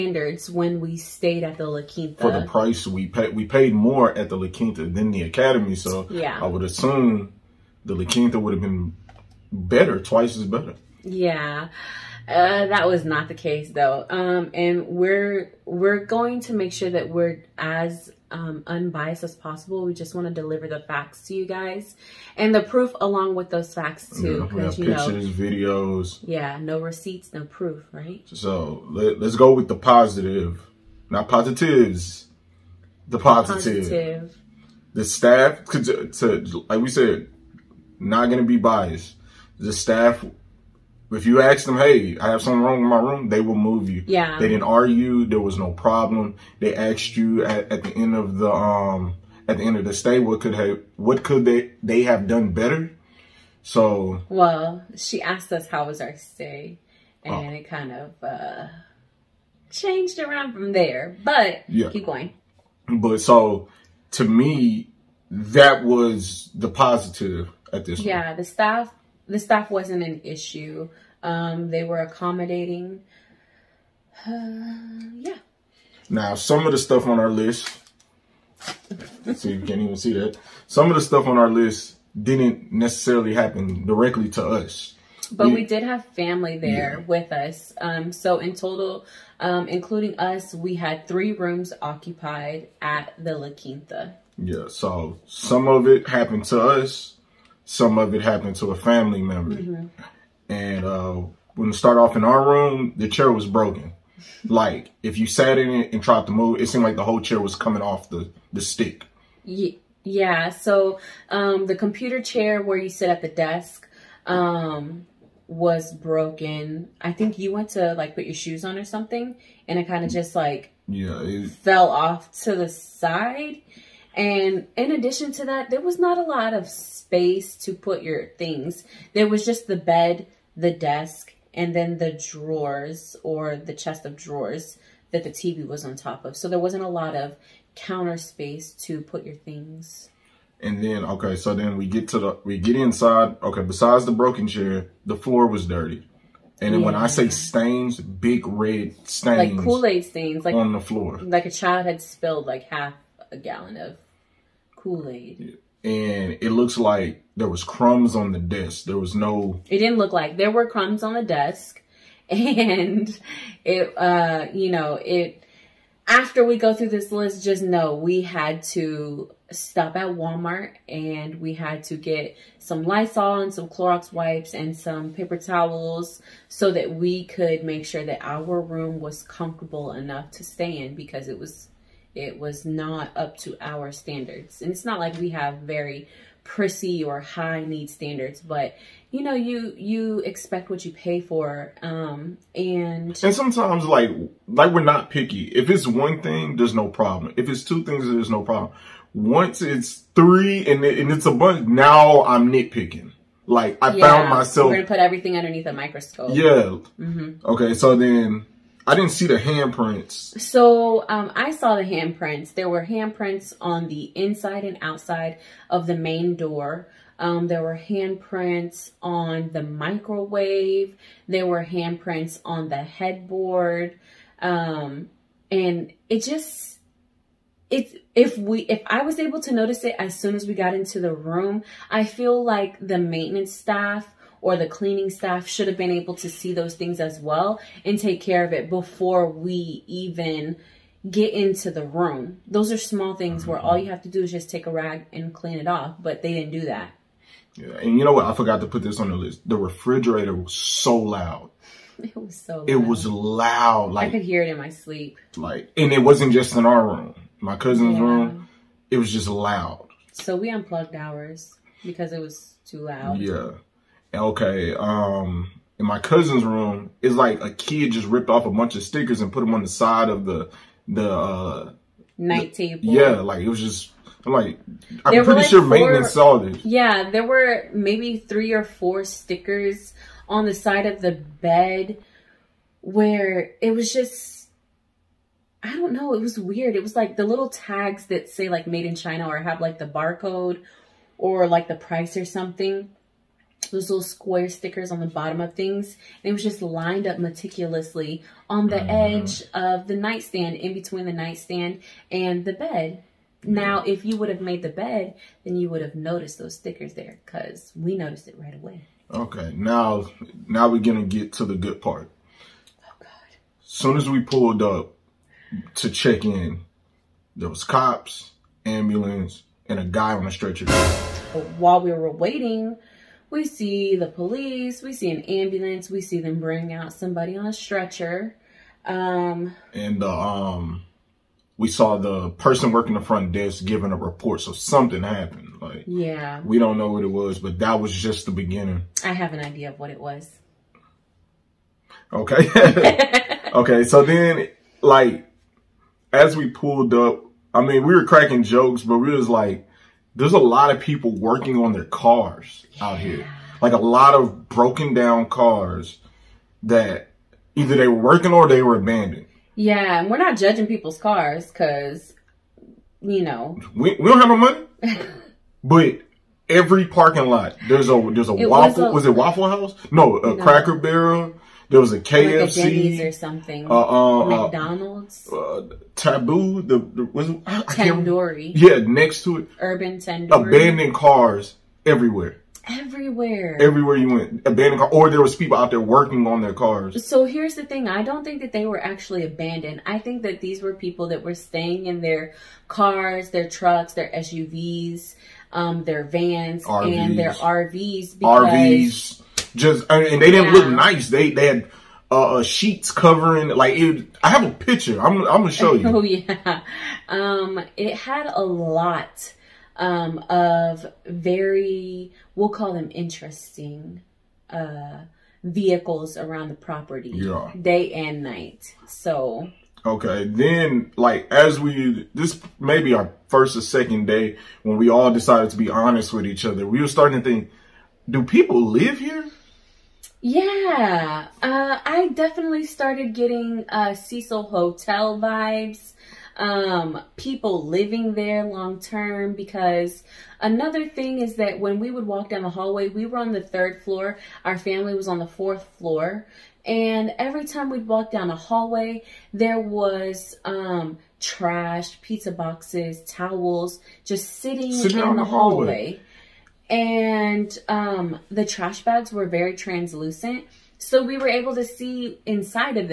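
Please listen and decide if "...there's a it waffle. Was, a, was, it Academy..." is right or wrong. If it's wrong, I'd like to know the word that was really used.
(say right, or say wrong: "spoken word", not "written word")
wrong: "Waffle", not "Academy".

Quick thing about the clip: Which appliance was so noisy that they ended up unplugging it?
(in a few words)
refrigerator.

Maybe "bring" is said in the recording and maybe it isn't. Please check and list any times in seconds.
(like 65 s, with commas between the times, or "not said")
326 s.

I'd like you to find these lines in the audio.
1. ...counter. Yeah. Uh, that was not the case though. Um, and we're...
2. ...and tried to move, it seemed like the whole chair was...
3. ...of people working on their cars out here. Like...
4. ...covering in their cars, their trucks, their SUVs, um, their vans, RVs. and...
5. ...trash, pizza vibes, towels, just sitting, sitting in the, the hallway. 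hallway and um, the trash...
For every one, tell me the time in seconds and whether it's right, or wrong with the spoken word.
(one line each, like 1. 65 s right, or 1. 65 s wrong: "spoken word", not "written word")
1. 10 s wrong: "better", not "counter"
2. 105 s right
3. 350 s right
4. 391 s wrong: "staying", not "covering"
5. 451 s wrong: "boxes", not "vibes".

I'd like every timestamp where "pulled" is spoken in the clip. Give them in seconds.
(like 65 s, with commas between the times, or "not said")
314 s, 346 s.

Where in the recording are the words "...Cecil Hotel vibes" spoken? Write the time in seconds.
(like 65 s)
433 s.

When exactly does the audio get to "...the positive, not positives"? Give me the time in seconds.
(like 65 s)
29 s.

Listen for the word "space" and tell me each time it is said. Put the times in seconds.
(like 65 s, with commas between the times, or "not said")
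126 s, 138 s.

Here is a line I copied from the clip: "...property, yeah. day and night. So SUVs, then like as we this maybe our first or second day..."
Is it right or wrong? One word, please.
wrong.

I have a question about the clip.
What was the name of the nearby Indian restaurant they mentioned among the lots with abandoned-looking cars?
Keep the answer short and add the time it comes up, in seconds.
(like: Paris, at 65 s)
Urban Tandoori, at 379 s.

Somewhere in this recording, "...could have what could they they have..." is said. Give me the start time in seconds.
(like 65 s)
50 s.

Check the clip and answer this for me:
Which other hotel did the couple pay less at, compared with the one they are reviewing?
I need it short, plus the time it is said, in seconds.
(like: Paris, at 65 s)
Academy, at 5 s.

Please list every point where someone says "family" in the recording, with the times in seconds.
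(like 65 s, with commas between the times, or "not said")
86 s, 98 s, 444 s.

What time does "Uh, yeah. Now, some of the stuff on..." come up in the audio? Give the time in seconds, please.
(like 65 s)
74 s.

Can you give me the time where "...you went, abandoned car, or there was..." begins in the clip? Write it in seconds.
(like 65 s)
383 s.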